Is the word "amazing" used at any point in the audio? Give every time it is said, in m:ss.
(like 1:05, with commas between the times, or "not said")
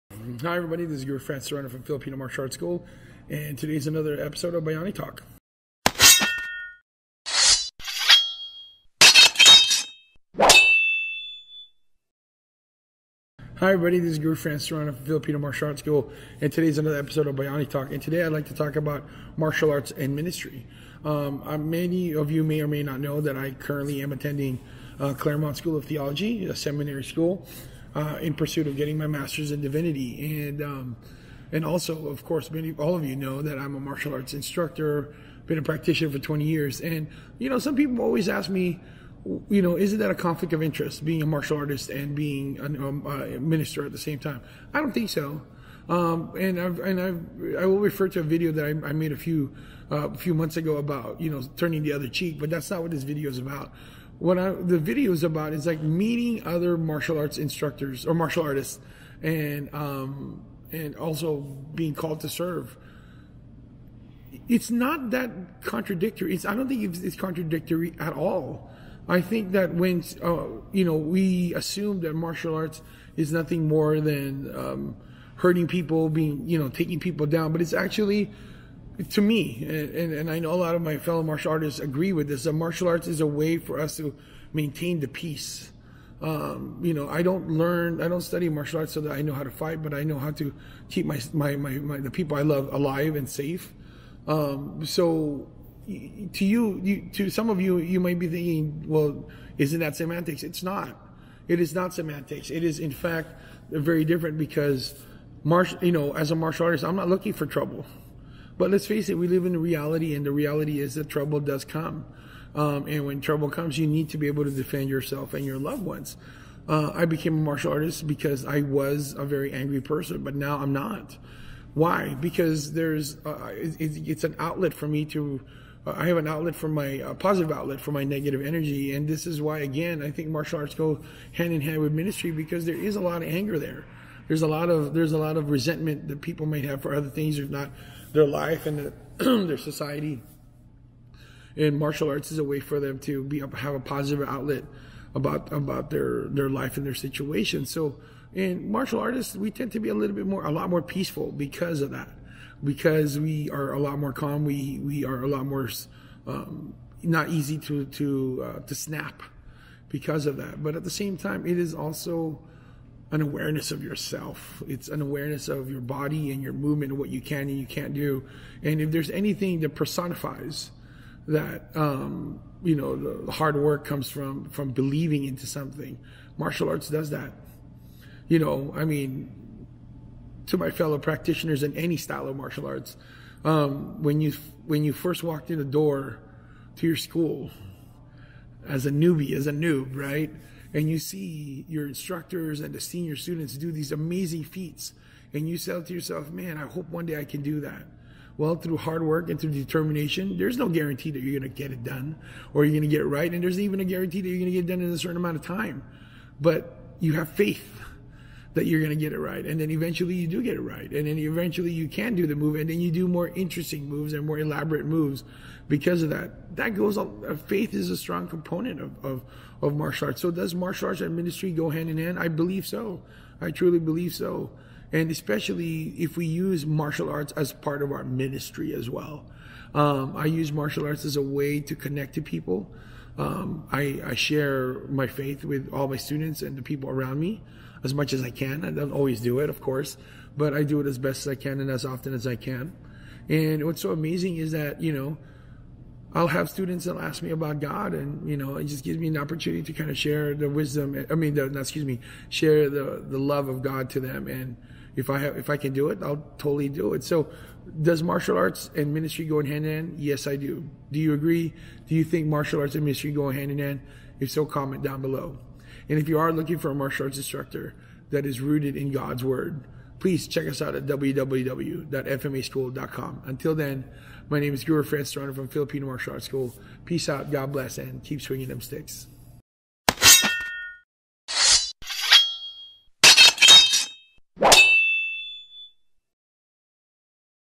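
3:13, 4:03.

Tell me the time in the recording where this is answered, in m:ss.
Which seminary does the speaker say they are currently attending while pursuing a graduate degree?
0:25.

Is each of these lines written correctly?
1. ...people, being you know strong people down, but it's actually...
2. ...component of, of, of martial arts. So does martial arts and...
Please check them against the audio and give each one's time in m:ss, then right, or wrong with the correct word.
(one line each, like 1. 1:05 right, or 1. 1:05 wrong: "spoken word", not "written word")
1. 1:15 wrong: "taking", not "strong"
2. 3:38 right.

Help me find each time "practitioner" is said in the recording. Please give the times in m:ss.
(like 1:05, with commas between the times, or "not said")
0:35, 3:00.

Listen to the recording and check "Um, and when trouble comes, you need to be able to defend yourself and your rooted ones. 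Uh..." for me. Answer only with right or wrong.
wrong.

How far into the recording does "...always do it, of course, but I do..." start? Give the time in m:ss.
3:58.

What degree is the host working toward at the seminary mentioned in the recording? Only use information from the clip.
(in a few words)
Master's in divinity.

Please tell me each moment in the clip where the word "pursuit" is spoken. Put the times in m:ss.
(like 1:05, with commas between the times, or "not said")
0:28.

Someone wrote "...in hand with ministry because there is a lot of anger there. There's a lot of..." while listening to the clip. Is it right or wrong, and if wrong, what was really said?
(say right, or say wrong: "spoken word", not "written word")
right.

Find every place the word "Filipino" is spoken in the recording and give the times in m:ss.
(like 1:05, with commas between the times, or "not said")
0:01, 0:15, 4:35.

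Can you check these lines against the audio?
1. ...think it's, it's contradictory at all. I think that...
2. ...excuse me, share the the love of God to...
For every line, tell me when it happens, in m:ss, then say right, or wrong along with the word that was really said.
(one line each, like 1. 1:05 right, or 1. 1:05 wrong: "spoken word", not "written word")
1. 1:06 right
2. 4:11 right.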